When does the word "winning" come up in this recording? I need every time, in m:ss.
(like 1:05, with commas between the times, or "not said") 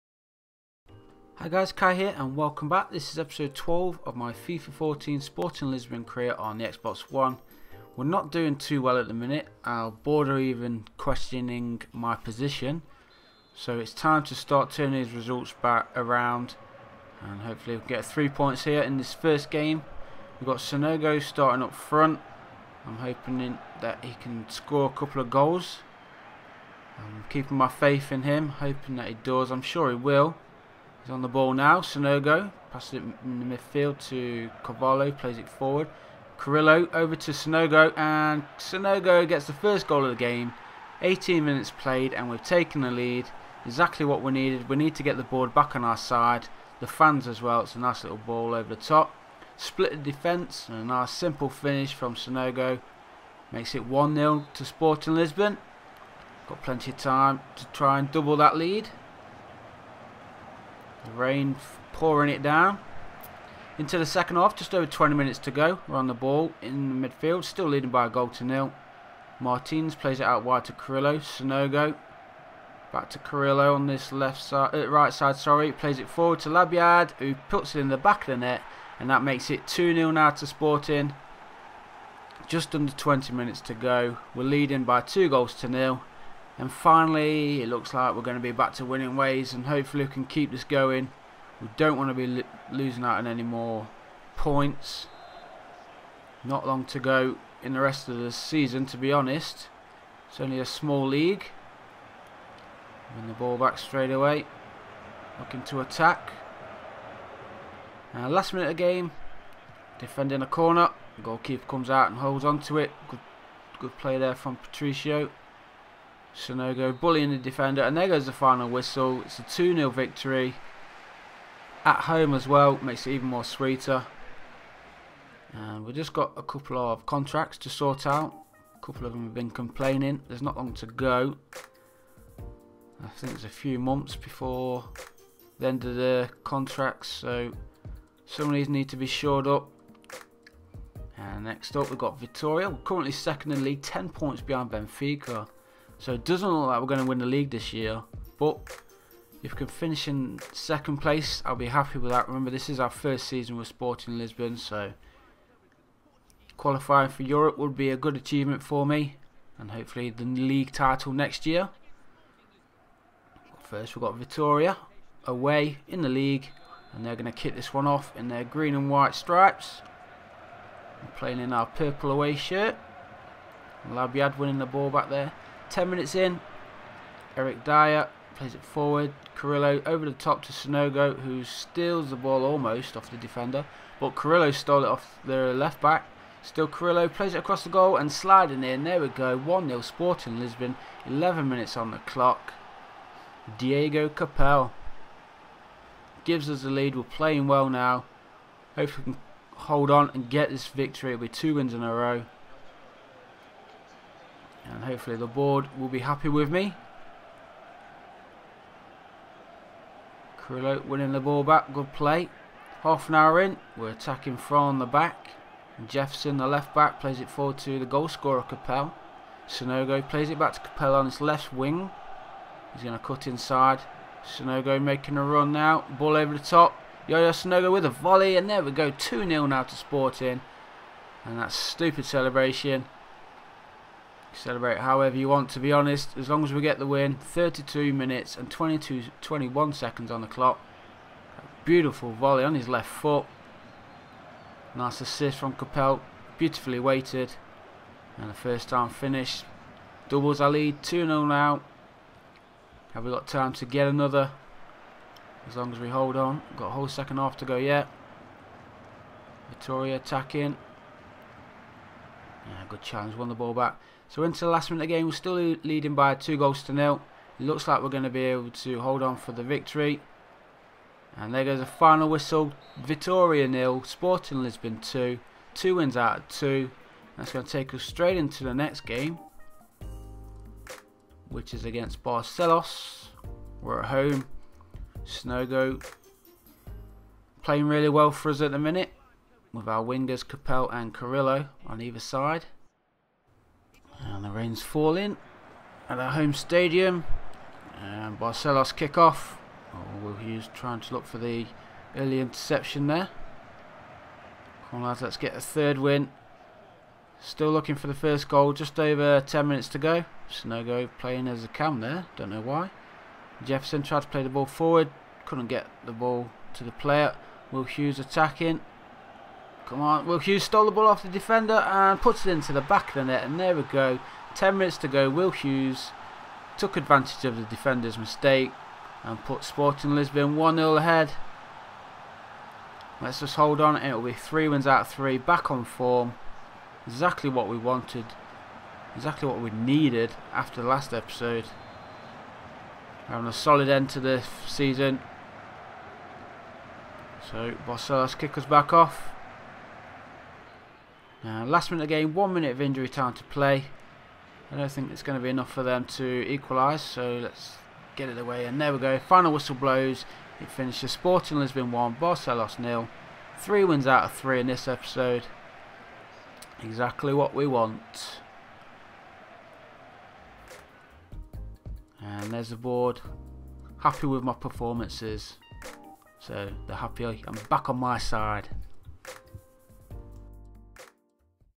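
1:28, 2:54, 3:30.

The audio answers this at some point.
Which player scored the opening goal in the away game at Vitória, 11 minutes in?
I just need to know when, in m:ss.
3:13.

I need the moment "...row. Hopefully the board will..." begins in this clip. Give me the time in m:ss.
3:21.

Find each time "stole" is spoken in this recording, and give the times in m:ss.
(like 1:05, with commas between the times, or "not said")
3:04, 5:20.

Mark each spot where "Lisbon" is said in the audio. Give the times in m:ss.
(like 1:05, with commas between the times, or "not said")
0:05, 0:55, 2:34, 3:10, 4:34, 5:29, 6:01.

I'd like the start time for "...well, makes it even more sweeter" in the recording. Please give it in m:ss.
2:02.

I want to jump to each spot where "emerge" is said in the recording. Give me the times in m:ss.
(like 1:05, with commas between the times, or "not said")
not said.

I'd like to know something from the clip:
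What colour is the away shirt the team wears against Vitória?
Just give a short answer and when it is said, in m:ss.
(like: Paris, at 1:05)
Purple, at 2:51.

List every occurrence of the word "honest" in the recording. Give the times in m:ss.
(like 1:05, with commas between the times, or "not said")
1:39, 3:55.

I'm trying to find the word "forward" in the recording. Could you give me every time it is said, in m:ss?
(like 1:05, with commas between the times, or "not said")
0:35, 1:16, 2:58, 3:37, 5:14.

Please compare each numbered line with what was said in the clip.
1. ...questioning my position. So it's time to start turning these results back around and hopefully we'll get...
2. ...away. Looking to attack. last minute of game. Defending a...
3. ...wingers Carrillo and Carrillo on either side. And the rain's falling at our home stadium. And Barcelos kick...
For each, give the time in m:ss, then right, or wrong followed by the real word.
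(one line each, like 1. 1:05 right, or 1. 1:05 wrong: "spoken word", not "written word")
1. 0:10 right
2. 1:44 right
3. 4:49 wrong: "Capel", not "Carrillo".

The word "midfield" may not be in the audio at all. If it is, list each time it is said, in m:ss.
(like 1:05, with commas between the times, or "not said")
0:33, 1:07.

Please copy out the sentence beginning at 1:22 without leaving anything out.
Just under 20 minutes to go.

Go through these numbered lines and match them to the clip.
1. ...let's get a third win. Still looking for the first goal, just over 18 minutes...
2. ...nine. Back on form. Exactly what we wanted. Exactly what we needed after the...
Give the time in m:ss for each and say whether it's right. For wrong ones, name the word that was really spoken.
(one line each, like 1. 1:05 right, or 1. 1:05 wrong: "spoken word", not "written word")
1. 5:05 wrong: "10", not "18"
2. 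5:34 wrong: "three", not "nine".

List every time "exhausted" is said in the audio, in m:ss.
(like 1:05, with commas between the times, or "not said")
not said.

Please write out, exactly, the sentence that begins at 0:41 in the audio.
18 minutes played, and we've taken the lead.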